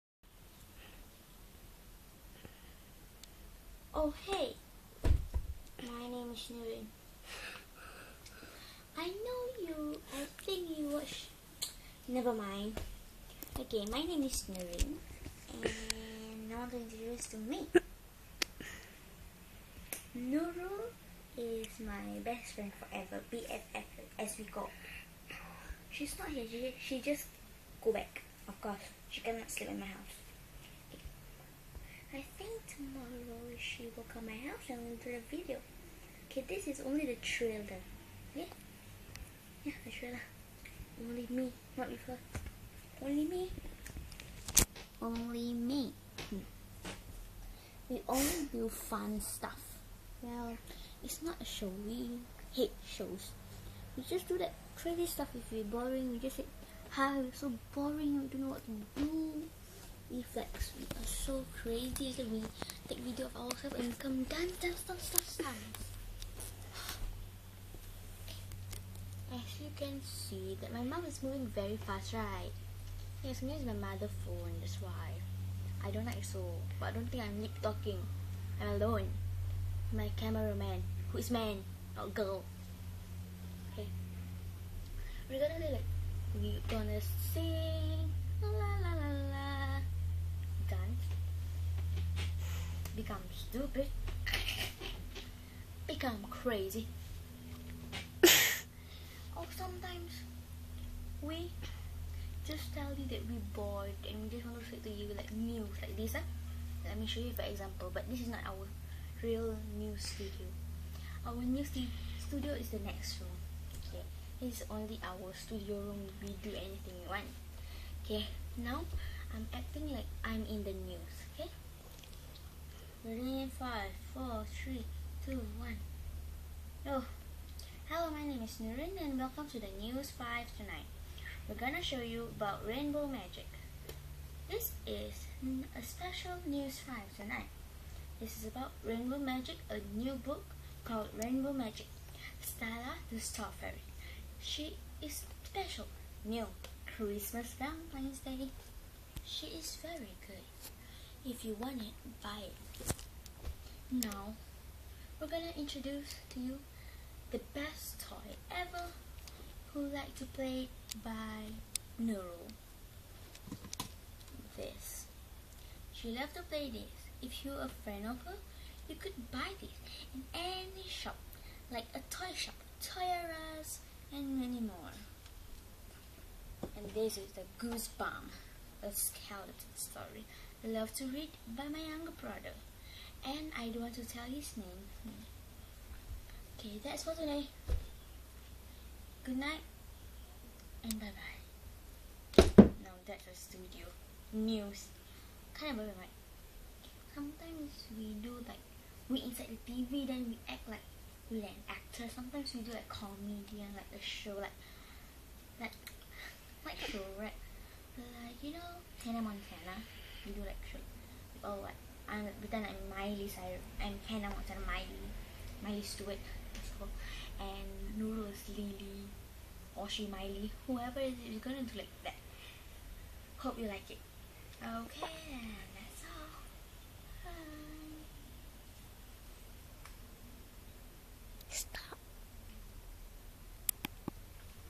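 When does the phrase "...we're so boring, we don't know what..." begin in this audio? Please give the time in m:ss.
0:57.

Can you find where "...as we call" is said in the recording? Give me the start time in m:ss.
0:24.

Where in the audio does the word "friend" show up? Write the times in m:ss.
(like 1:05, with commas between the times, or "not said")
0:22, 2:47.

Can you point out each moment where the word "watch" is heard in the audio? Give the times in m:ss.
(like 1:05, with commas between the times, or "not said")
0:10.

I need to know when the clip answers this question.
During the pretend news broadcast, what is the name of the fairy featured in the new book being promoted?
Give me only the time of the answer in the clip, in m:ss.
2:22.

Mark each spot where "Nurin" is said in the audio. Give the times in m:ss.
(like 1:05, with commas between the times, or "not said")
0:06, 0:14, 2:08.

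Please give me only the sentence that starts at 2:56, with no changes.
And this is the Goosebump, a skeleton story.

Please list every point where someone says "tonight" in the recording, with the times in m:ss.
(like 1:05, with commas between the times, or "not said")
2:10, 2:17.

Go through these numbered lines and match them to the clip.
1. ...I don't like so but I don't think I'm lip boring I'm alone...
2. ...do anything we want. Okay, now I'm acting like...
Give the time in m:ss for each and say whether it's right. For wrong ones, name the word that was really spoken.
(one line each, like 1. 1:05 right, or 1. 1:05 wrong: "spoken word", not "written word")
1. 1:15 wrong: "talking", not "boring"
2. 1:56 right.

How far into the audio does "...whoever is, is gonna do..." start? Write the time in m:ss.
3:40.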